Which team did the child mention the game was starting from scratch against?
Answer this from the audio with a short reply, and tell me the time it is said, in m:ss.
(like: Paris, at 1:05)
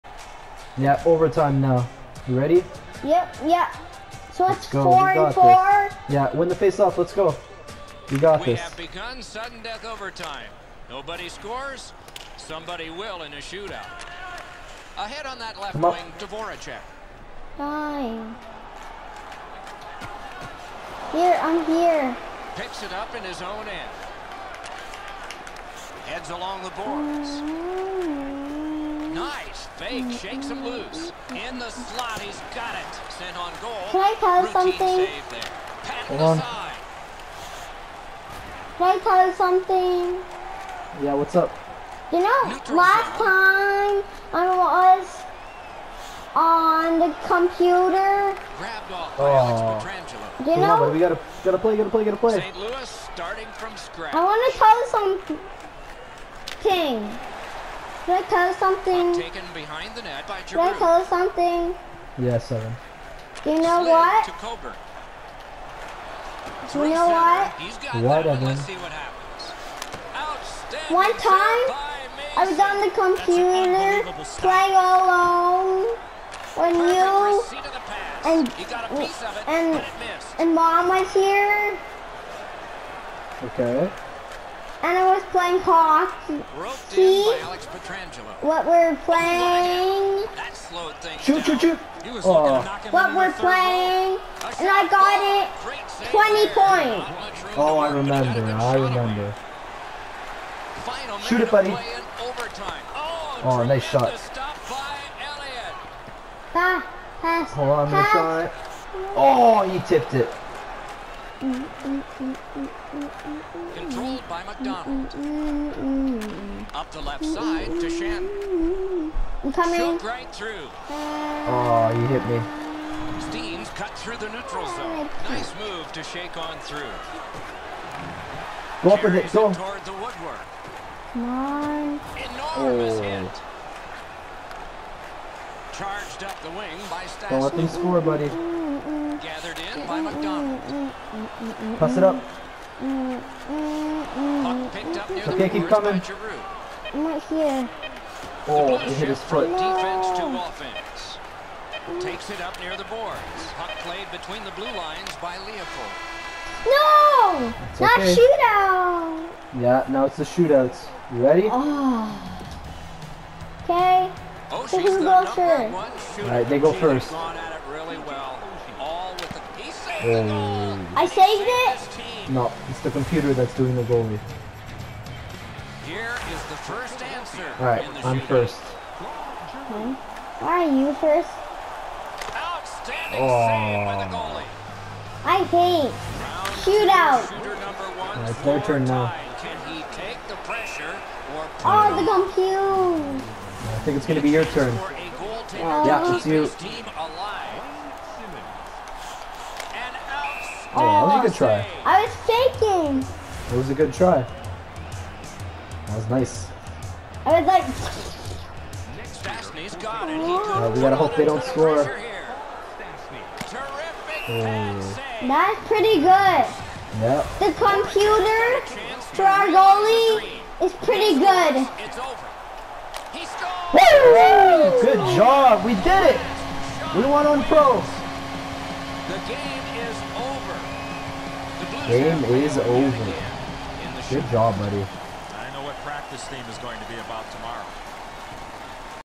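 St. Louis, at 0:52.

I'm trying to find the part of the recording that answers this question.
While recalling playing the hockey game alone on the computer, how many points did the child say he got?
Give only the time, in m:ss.
1:36.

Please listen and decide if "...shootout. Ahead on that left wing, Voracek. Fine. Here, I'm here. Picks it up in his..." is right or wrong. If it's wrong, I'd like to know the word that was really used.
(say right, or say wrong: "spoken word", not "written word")
right.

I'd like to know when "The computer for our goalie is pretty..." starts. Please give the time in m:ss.
3:37.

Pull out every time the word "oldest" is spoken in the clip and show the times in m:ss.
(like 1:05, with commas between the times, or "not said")
not said.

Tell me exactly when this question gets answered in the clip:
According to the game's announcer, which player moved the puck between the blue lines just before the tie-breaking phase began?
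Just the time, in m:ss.
2:35.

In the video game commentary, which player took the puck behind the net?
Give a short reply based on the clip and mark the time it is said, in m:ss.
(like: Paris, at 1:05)
Giroux, at 1:00.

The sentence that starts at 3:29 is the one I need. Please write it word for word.
Uh, we gotta hope they don't score.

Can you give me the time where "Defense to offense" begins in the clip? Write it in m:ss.
2:29.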